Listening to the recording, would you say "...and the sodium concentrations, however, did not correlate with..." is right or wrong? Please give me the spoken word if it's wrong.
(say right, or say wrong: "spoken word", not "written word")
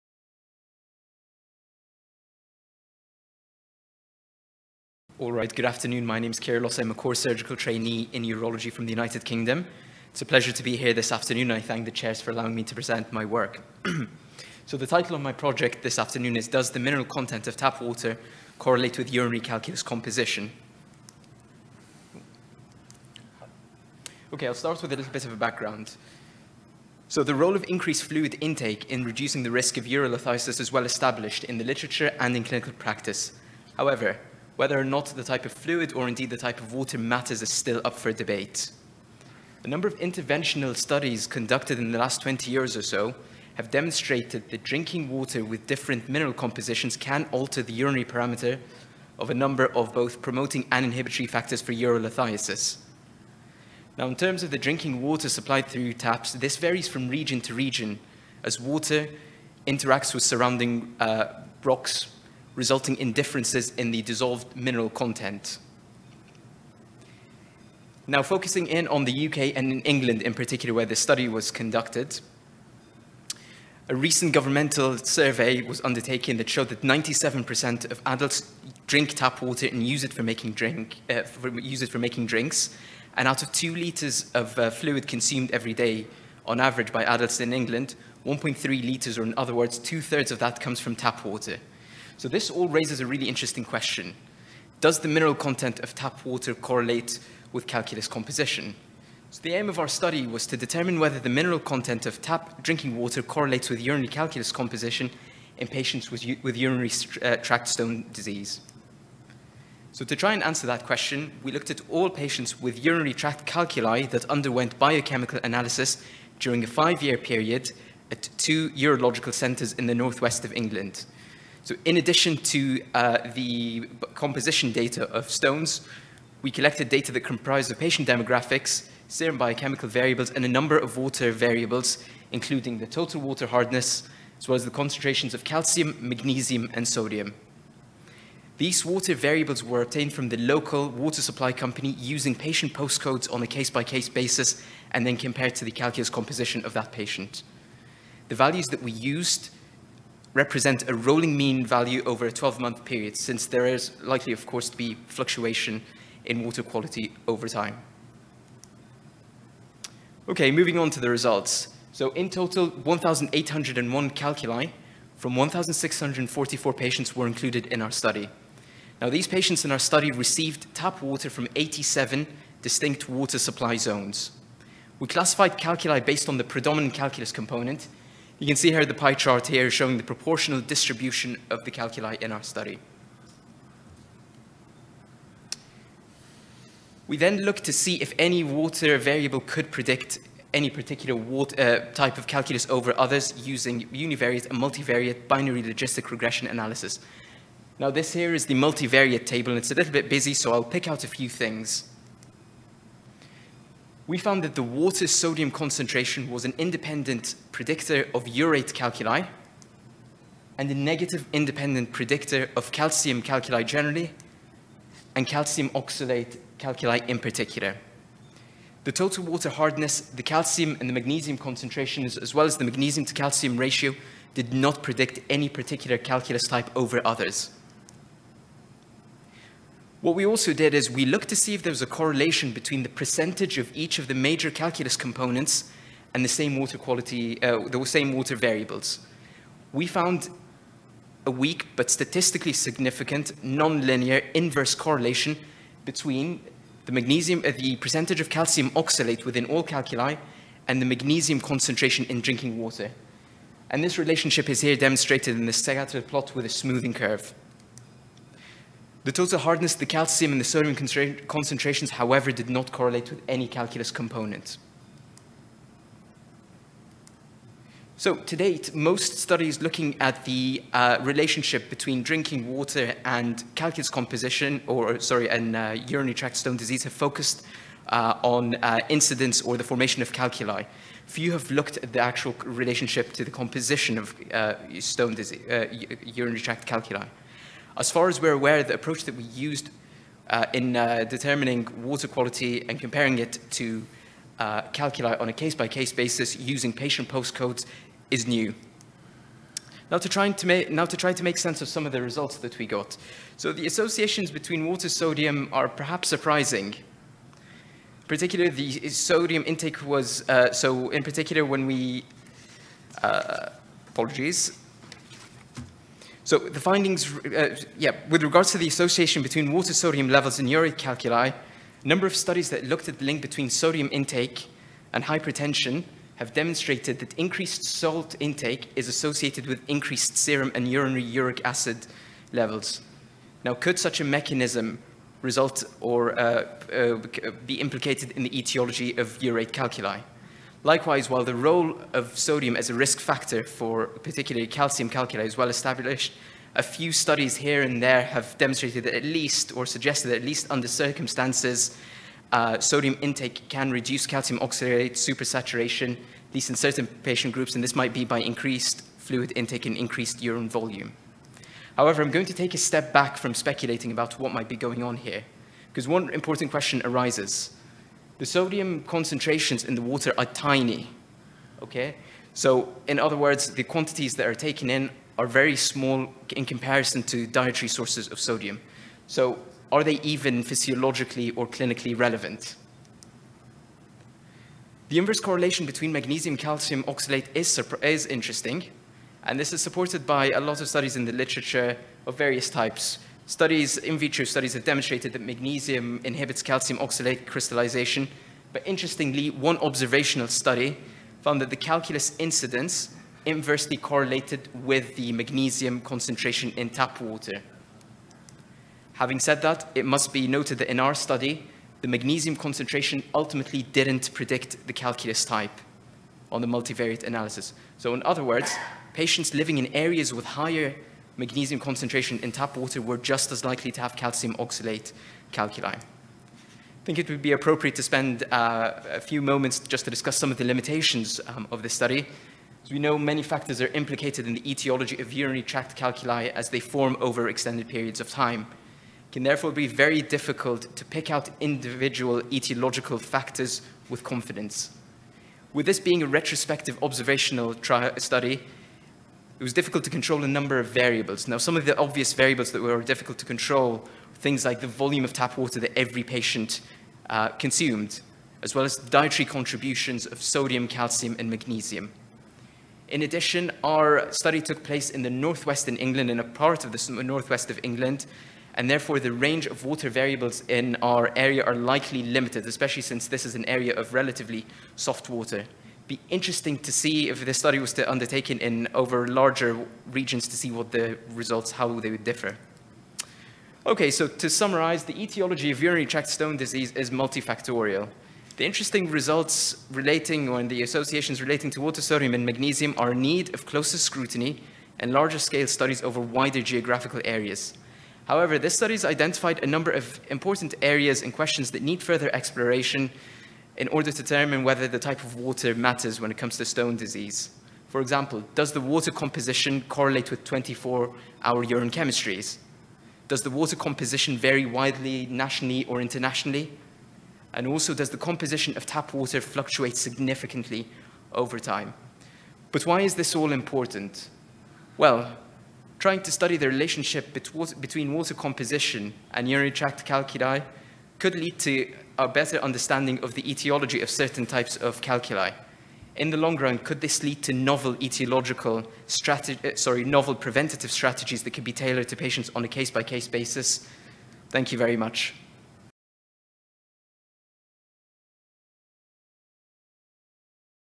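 right.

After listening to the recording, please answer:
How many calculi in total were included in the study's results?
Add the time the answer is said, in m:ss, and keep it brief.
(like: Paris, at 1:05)
1,801, at 2:42.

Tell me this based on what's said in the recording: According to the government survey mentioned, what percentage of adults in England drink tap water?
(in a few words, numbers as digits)
97%.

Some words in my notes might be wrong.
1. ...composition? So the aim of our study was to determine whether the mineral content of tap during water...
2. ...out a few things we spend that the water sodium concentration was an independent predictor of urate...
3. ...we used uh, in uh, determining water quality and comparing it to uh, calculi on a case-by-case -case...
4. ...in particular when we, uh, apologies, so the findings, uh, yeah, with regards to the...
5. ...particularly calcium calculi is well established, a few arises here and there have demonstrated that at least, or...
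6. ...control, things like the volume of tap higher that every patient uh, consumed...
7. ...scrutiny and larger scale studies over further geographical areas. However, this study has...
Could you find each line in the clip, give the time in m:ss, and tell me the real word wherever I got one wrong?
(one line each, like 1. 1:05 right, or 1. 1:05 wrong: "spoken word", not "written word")
1. 1:38 wrong: "drinking", not "during"
2. 3:20 wrong: "found", not "spend"
3. 4:49 right
4. 5:10 right
5. 5:43 wrong: "studies", not "arises"
6. 7:33 wrong: "water", not "higher"
7. 8:13 wrong: "wider", not "further".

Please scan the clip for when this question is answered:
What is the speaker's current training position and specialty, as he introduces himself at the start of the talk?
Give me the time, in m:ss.
0:06.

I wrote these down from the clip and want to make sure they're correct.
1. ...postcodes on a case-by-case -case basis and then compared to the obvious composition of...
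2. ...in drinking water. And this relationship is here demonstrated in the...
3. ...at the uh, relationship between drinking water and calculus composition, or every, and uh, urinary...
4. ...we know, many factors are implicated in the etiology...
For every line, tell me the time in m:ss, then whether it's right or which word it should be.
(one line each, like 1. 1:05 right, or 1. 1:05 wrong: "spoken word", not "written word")
1. 2:22 wrong: "calculus", not "obvious"
2. 4:12 right
3. 4:29 wrong: "sorry", not "every"
4. 7:12 right.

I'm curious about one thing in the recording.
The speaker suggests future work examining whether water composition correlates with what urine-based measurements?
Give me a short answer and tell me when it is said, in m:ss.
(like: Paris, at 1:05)
24-hour urine chemistries, at 8:30.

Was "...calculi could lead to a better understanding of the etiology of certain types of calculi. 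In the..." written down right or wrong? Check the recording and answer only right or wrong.
right.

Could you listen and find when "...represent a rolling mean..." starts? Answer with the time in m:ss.
2:30.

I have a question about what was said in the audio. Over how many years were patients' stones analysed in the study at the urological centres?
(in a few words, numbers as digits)
5 years.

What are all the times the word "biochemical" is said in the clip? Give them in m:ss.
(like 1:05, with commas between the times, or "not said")
1:54, 2:09.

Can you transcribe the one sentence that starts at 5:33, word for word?
Now, could such a mechanism result or uh, uh, be implicated in the etiology of urate calculi?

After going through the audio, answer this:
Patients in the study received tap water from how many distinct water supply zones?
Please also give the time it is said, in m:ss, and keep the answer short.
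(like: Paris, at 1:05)
87, at 2:51.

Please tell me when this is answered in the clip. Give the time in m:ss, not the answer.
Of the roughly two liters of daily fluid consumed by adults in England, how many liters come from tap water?
1:28.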